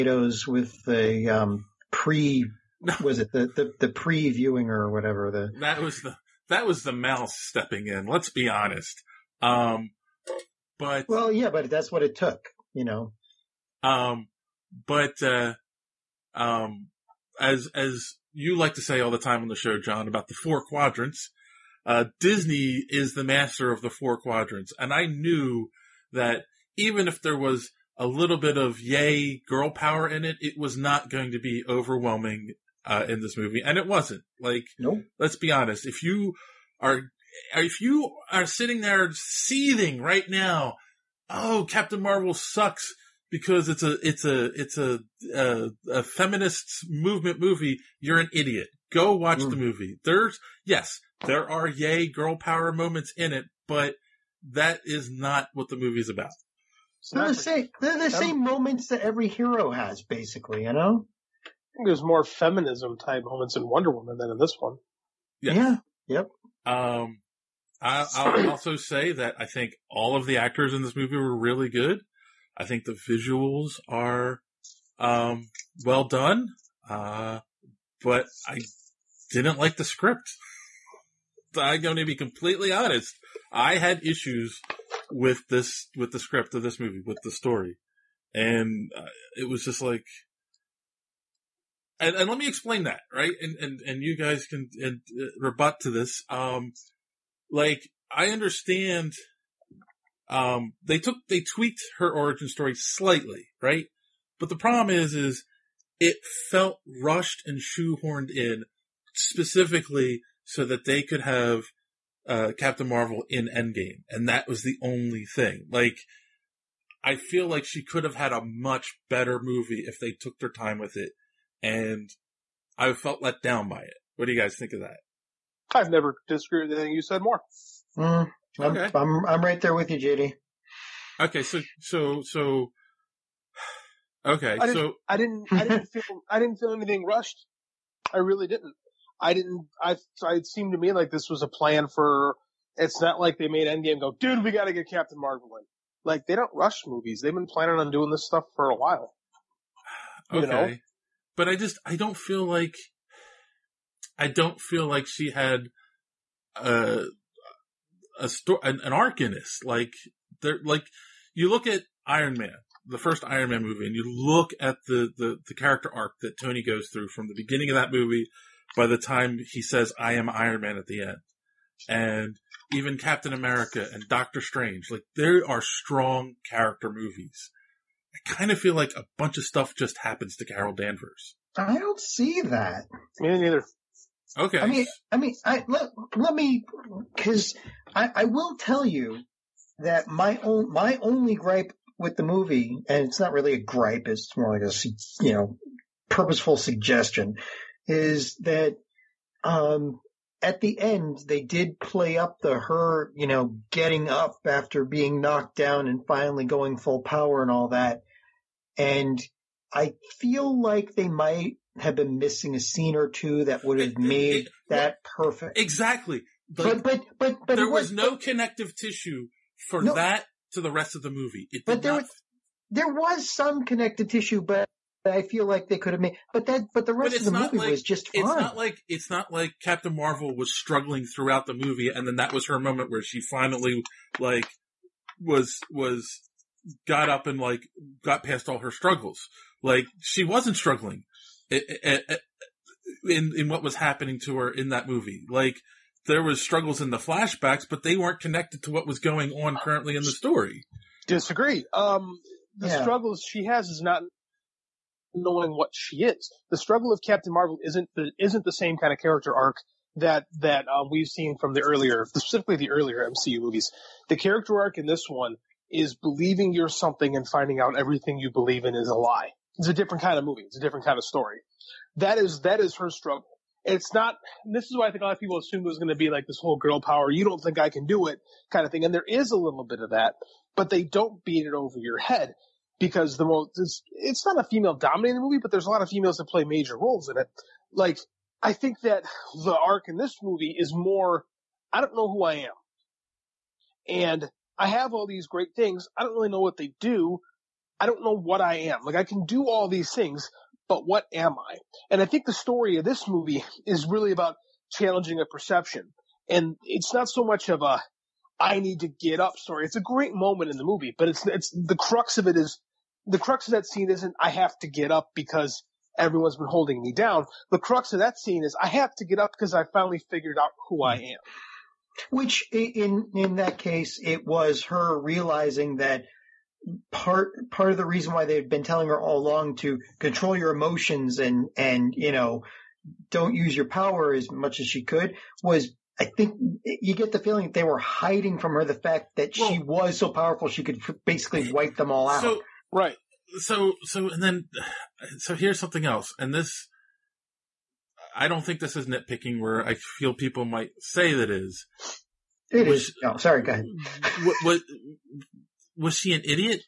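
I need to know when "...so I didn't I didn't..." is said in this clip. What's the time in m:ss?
2:14.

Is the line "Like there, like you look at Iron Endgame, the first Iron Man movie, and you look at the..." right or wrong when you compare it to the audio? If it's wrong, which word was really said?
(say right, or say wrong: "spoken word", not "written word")
wrong: "Man", not "Endgame".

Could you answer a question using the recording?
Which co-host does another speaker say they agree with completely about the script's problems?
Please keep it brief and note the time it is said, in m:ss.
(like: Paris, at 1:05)
JD, at 2:09.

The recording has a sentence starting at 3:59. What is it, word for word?
Like she wasn't struggling eh, eh, eh, in in what was happening to her in that movie.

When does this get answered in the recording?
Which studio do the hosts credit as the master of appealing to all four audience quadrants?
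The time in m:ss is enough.
0:22.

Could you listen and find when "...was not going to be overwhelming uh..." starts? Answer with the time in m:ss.
0:30.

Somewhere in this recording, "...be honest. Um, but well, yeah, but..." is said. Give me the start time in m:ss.
0:08.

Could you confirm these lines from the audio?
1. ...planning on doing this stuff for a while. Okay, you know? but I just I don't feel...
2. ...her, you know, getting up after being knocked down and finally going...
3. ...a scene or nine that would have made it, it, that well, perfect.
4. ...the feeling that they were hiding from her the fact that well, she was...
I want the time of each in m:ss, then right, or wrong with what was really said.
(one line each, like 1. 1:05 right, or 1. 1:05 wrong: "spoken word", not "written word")
1. 2:27 right
2. 3:22 right
3. 3:32 wrong: "two", not "nine"
4. 5:37 right.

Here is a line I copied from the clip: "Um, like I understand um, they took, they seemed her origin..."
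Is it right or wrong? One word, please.
wrong.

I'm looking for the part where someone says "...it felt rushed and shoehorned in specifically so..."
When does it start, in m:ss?
1:45.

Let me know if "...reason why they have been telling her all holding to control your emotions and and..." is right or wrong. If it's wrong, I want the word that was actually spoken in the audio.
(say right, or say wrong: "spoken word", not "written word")
wrong: "along", not "holding".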